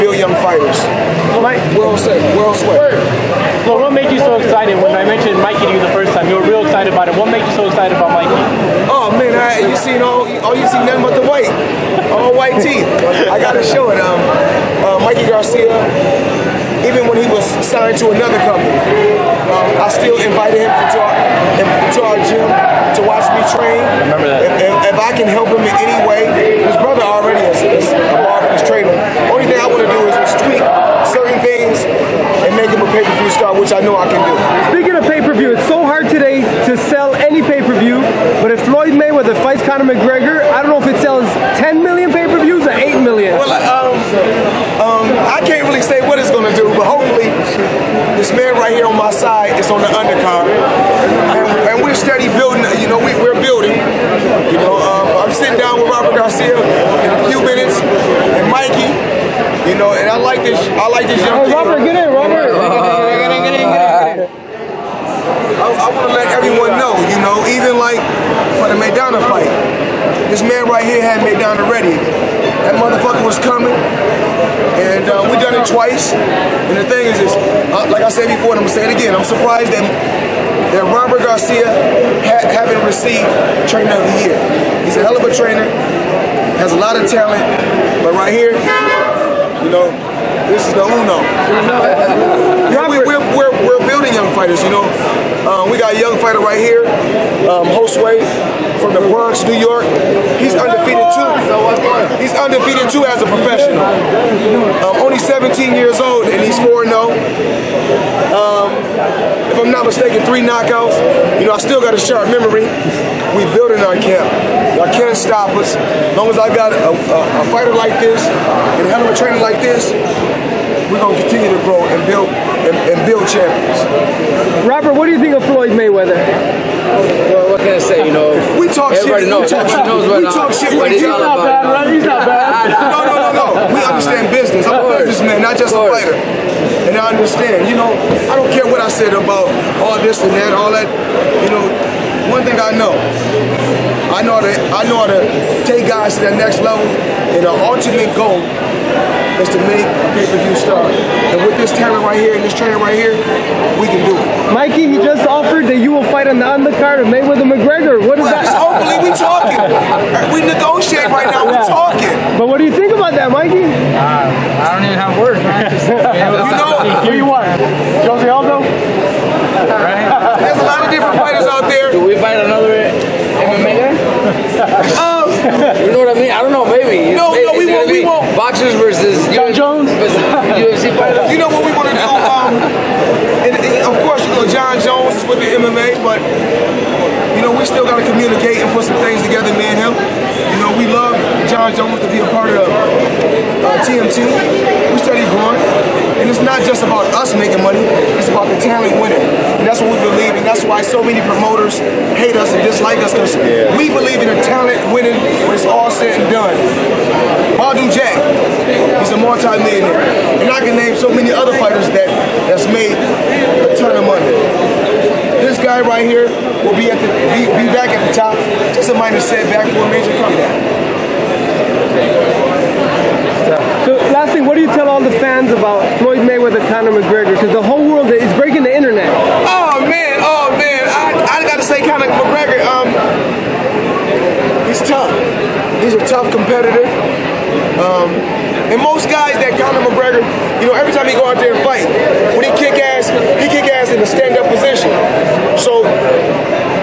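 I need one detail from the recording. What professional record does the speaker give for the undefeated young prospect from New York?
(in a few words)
4-0.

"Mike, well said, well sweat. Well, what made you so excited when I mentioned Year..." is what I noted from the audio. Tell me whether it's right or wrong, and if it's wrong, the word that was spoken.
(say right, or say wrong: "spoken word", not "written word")
wrong: "Mikey", not "Year".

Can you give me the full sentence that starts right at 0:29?
Only thing I want to do is tweak certain things and make him a pay-per-view star, which I know I can do.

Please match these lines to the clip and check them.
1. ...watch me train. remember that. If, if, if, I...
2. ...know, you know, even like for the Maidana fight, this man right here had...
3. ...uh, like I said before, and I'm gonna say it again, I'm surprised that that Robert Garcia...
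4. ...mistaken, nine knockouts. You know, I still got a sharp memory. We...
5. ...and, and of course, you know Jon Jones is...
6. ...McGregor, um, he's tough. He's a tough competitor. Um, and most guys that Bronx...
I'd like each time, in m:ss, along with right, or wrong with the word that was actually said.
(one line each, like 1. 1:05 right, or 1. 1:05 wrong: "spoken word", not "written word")
1. 0:23 right
2. 1:06 right
3. 1:17 right
4. 1:49 wrong: "three", not "nine"
5. 3:03 right
6. 3:52 wrong: "Conor", not "Bronx".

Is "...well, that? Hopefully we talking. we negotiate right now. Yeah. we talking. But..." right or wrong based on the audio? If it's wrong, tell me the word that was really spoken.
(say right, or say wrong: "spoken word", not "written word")
right.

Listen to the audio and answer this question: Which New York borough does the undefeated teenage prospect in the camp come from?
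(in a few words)
the Bronx.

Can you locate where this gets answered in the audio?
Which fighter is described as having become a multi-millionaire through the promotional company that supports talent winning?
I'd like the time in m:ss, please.
3:27.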